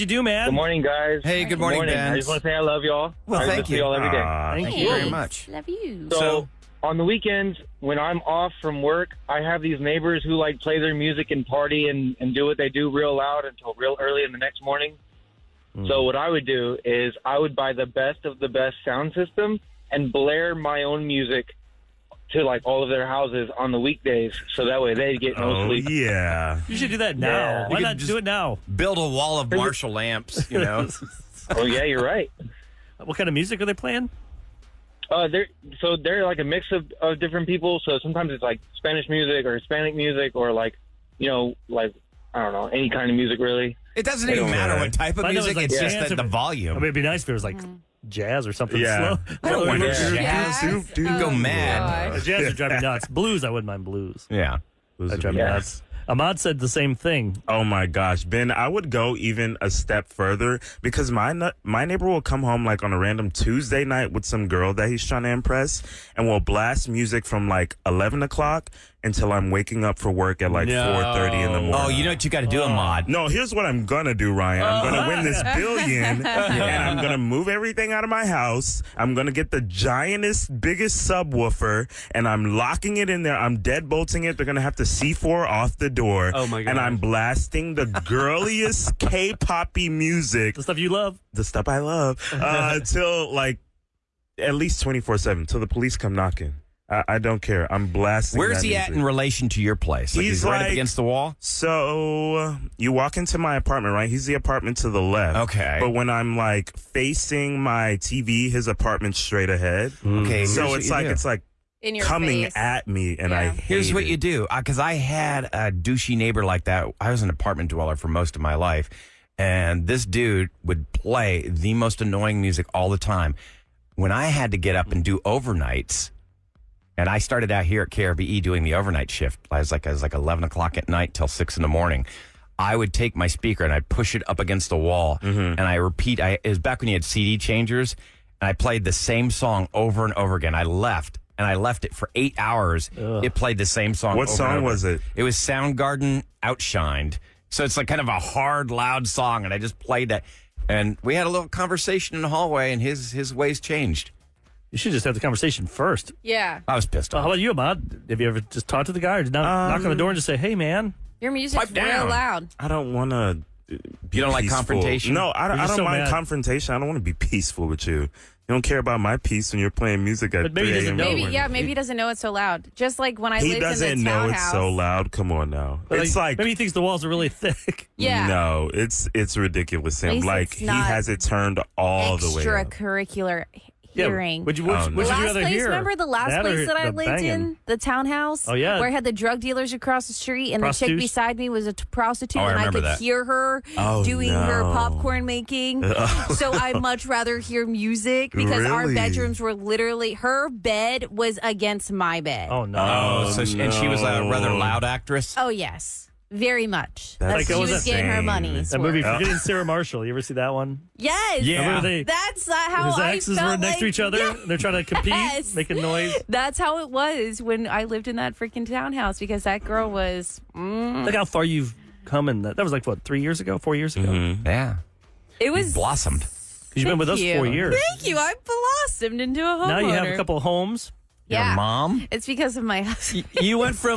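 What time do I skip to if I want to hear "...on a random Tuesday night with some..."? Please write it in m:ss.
1:02.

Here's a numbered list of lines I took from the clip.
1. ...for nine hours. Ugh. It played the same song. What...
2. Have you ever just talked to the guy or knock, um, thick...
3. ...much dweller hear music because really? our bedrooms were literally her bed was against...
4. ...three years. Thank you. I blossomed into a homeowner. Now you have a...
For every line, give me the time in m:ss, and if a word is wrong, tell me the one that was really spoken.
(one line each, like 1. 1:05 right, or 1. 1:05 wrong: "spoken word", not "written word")
1. 2:21 wrong: "eight", not "nine"
2. 2:38 wrong: "knock", not "thick"
3. 3:16 wrong: "rather", not "dweller"
4. 3:47 wrong: "four", not "three".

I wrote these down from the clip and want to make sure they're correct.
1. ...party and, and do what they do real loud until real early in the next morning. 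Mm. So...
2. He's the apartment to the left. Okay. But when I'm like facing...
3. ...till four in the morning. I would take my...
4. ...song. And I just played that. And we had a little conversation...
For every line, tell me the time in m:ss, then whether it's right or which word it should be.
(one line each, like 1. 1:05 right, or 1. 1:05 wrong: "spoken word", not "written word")
1. 0:11 right
2. 1:44 right
3. 2:11 wrong: "six", not "four"
4. 2:29 right.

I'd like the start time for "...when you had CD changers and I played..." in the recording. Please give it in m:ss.
2:16.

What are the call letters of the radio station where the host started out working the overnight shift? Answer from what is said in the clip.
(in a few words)
KRBE.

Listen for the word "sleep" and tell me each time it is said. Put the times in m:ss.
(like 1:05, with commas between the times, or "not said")
0:25.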